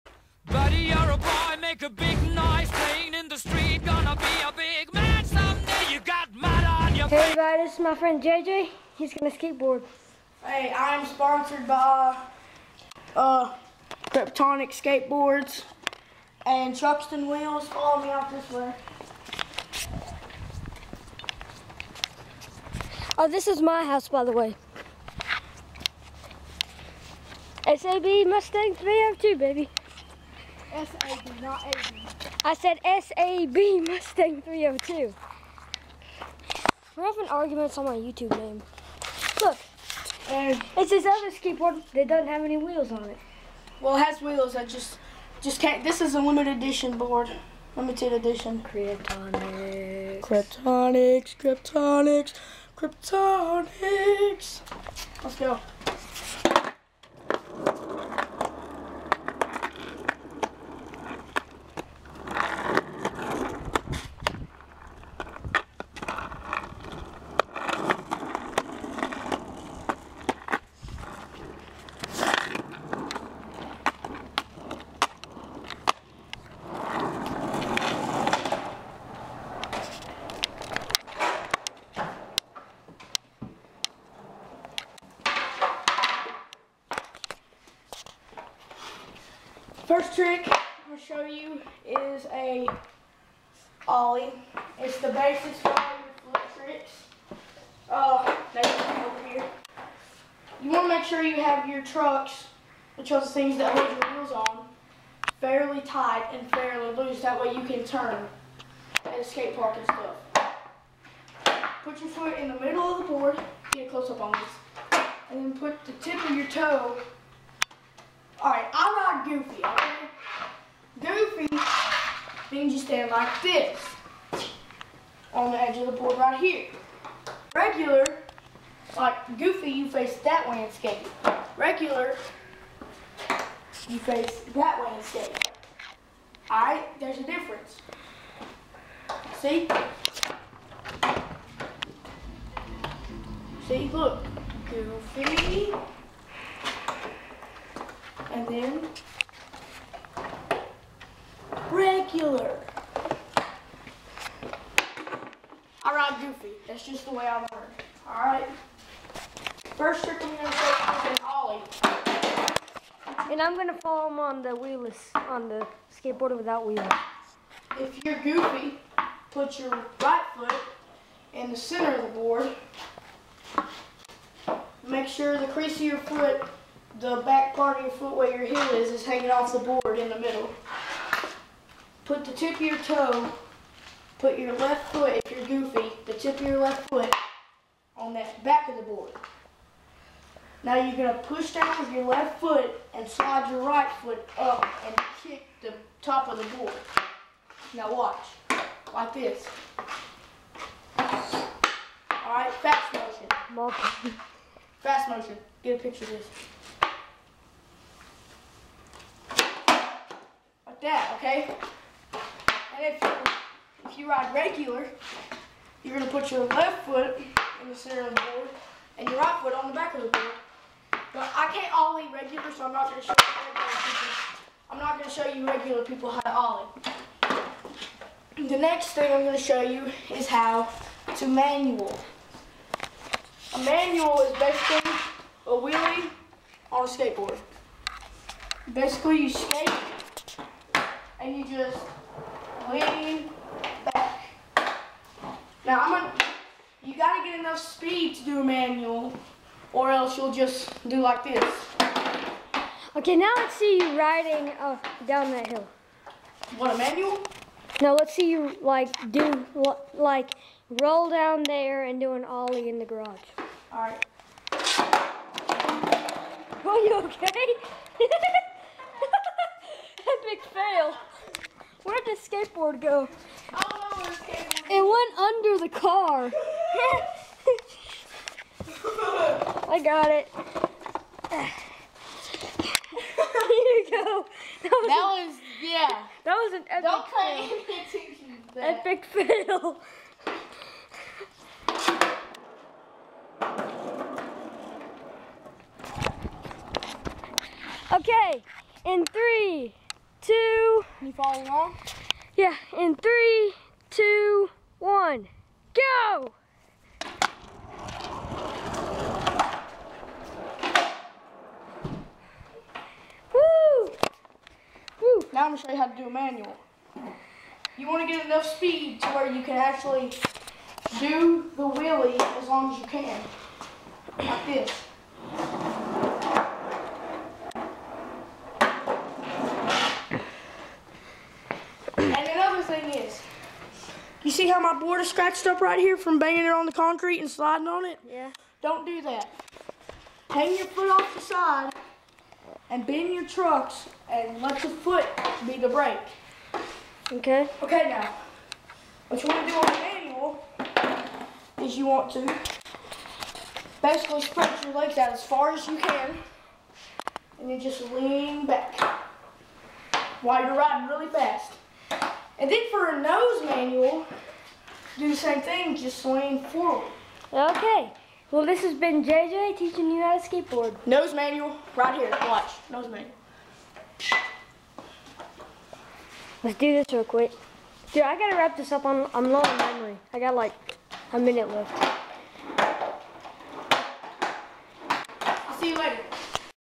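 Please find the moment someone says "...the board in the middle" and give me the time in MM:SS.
02:59.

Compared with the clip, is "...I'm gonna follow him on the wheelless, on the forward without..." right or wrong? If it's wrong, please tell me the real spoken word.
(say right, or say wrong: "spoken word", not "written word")
wrong: "skateboard", not "forward".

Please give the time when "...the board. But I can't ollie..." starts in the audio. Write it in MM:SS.
03:40.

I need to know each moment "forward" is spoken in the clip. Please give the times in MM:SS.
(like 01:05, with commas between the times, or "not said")
06:06.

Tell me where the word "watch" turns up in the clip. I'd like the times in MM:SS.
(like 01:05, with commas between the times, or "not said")
03:17, 06:12.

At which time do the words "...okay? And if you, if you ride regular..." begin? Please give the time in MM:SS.
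03:31.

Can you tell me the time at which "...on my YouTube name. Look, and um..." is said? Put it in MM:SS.
00:37.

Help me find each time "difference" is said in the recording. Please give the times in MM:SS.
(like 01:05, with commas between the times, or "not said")
02:17.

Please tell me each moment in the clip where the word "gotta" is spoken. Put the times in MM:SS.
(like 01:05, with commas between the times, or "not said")
04:06, 06:18.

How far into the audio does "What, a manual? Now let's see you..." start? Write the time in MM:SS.
04:16.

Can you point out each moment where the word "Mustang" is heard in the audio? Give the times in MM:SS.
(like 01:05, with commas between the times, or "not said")
00:28, 00:33.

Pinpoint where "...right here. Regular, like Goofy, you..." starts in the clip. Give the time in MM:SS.
02:06.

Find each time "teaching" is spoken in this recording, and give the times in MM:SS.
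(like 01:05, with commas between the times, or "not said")
06:09.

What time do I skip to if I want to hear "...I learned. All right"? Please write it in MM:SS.
02:37.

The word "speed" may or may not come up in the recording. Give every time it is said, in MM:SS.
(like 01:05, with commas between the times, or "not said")
04:07, 05:18.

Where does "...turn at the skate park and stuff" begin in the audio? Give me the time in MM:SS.
01:47.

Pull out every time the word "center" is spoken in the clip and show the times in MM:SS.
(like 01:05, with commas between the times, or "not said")
02:51, 03:37.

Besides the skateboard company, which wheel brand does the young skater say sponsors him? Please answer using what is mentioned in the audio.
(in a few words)
Truxton Wheels.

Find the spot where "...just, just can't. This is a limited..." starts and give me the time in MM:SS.
00:44.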